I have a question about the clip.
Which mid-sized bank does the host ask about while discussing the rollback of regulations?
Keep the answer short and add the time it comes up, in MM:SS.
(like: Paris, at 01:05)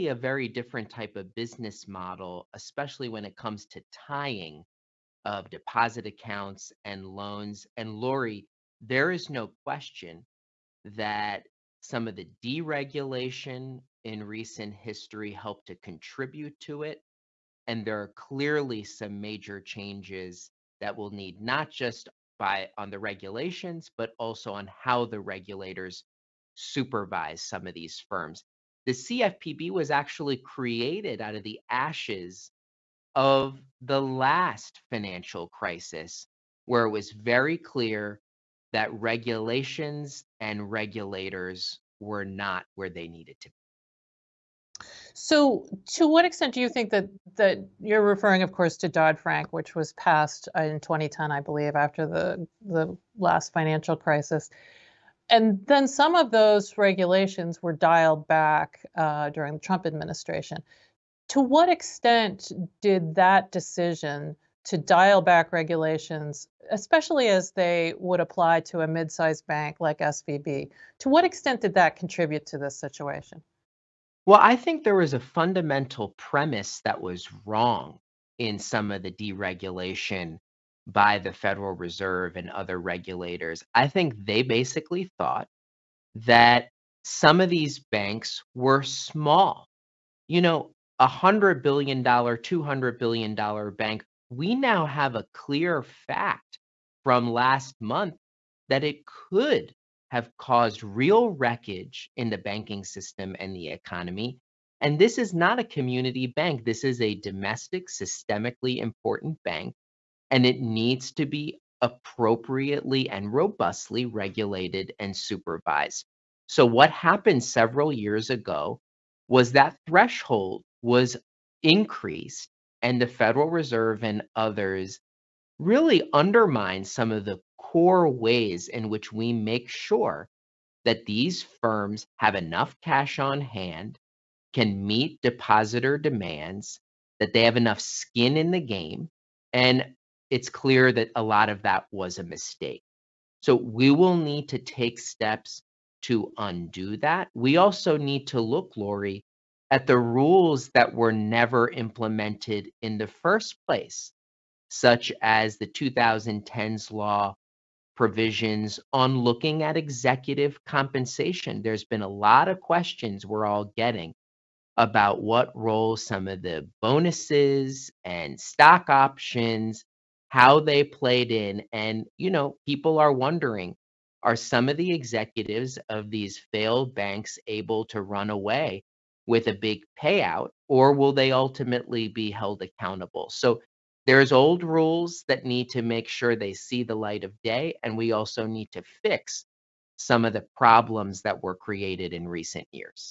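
SVB, at 01:09.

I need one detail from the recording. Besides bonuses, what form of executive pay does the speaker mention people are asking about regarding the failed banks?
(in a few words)
stock options.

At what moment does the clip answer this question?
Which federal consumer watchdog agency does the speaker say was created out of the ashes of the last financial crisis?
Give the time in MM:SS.
00:28.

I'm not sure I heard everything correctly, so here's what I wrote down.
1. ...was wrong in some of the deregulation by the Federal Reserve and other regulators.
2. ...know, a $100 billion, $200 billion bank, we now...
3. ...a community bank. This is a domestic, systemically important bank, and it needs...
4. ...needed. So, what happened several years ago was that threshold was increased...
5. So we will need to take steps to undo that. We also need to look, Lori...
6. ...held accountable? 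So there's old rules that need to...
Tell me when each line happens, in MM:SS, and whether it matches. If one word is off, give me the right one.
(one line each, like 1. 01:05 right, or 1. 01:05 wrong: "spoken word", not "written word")
1. 01:17 right
2. 01:30 right
3. 01:45 right
4. 01:55 wrong: "supervised", not "needed"
5. 02:23 right
6. 03:02 right.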